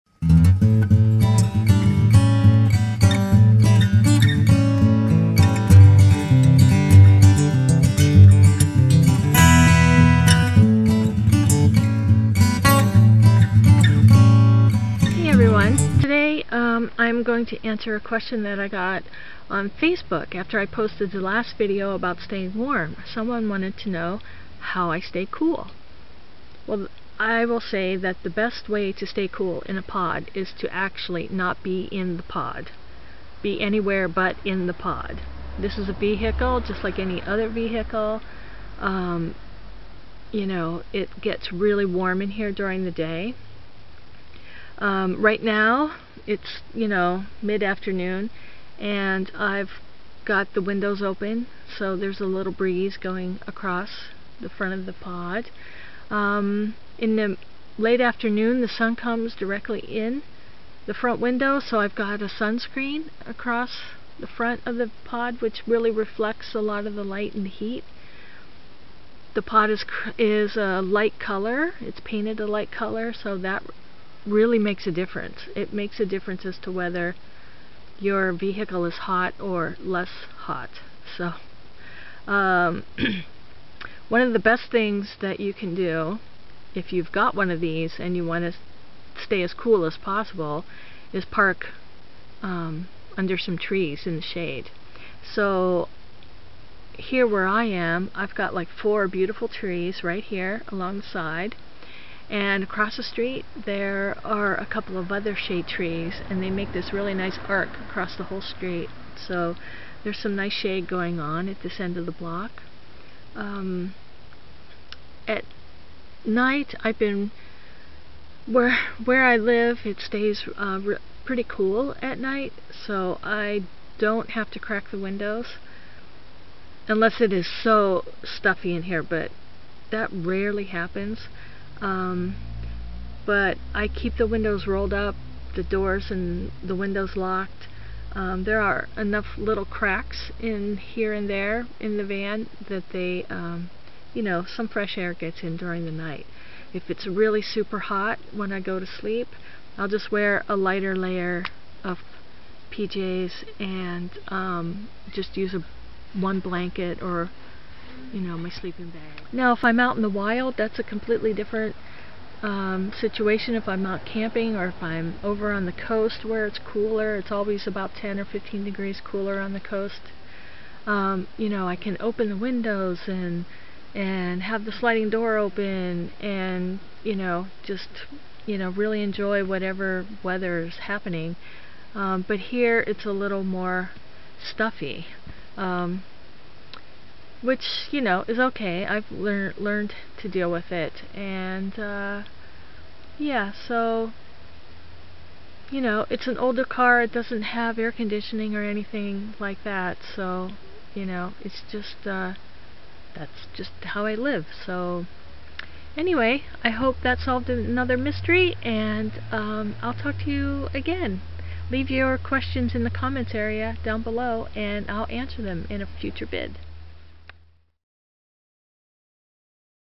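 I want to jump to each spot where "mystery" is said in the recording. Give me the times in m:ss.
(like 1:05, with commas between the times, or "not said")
3:27.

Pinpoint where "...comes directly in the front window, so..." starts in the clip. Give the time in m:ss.
0:58.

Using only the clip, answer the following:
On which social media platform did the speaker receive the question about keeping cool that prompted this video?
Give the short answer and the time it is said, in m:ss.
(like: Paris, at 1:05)
Facebook, at 0:19.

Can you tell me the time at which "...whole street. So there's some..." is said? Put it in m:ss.
1:48.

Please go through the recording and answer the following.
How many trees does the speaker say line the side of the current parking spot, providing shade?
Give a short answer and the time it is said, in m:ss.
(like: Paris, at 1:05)
4, at 1:38.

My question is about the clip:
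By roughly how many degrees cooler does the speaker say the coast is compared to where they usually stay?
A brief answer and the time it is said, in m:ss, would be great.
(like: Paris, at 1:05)
10 or 15, at 2:47.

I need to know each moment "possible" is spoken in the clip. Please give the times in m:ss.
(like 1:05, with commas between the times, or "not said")
1:29.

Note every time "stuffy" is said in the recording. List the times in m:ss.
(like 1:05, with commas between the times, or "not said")
2:08, 3:04.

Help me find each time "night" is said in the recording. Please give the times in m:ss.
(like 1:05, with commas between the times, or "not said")
1:56, 2:02, 2:25.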